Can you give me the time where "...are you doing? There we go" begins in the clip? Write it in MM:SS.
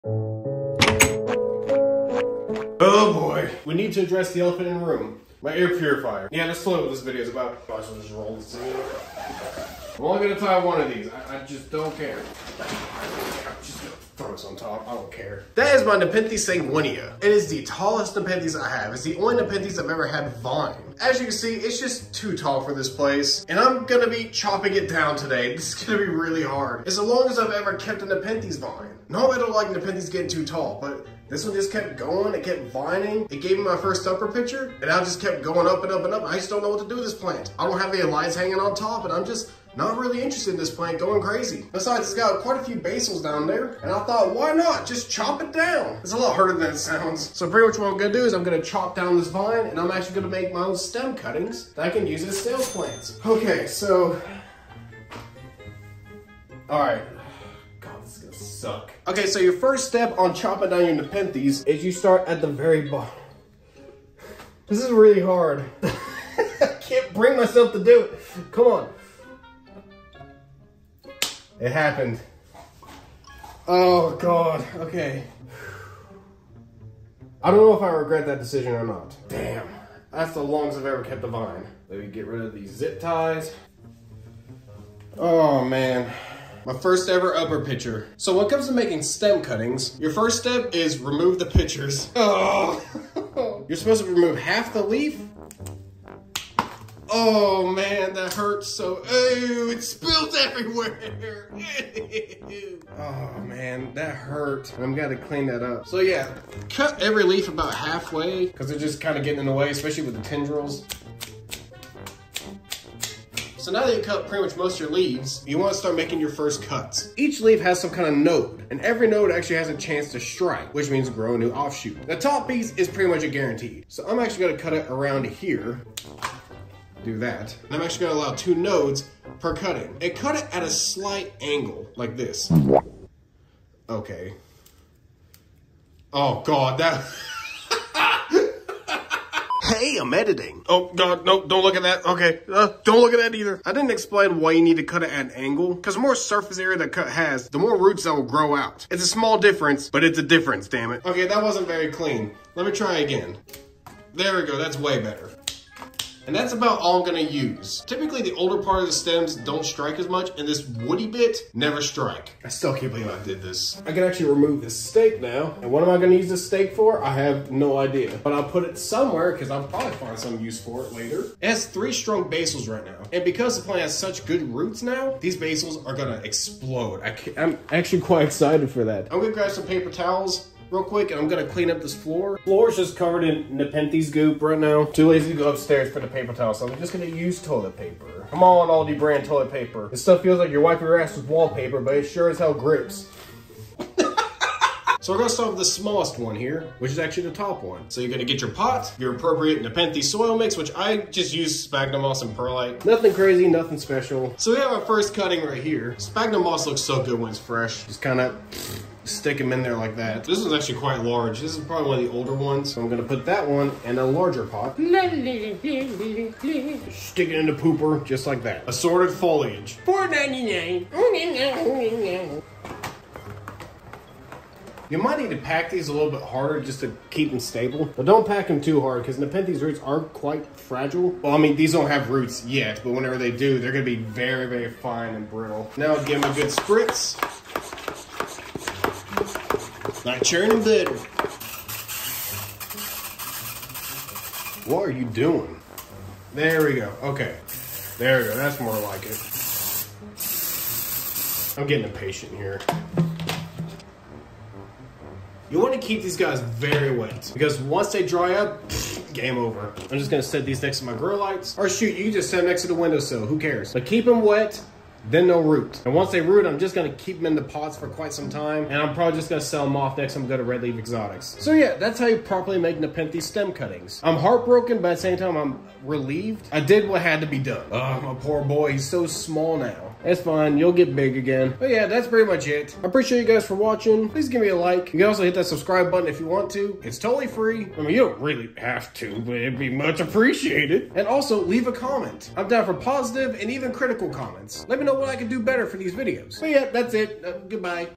04:04.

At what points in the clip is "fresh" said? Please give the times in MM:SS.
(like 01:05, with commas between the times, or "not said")
03:27.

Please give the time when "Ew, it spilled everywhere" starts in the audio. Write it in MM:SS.
01:39.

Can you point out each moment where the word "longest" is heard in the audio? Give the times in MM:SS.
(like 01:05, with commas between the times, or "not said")
00:27, 01:20.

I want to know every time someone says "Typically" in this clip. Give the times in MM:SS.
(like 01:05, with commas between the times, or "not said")
02:37.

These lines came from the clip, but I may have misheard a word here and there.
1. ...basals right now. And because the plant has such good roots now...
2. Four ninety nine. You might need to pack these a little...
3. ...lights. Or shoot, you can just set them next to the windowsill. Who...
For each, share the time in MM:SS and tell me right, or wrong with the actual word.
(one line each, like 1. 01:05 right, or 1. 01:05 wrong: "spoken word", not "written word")
1. 02:52 right
2. 03:39 right
3. 04:21 right.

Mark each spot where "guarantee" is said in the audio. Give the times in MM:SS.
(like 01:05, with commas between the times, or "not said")
02:03.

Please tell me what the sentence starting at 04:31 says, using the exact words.
So yeah, that's how you properly make Nepenthe stem cuttings.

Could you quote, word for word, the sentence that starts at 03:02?
Floor is just covered in Nepenthes goop right now.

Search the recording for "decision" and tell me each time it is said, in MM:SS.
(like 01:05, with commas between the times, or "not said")
01:18.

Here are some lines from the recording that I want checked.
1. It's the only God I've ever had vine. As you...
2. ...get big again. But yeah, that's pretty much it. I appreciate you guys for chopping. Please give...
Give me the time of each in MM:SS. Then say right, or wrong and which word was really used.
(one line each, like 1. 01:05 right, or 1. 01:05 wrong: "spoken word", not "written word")
1. 00:18 wrong: "Nepenthes", not "God"
2. 04:40 wrong: "watching", not "chopping".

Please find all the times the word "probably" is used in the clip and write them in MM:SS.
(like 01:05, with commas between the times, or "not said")
02:49, 03:31, 04:28.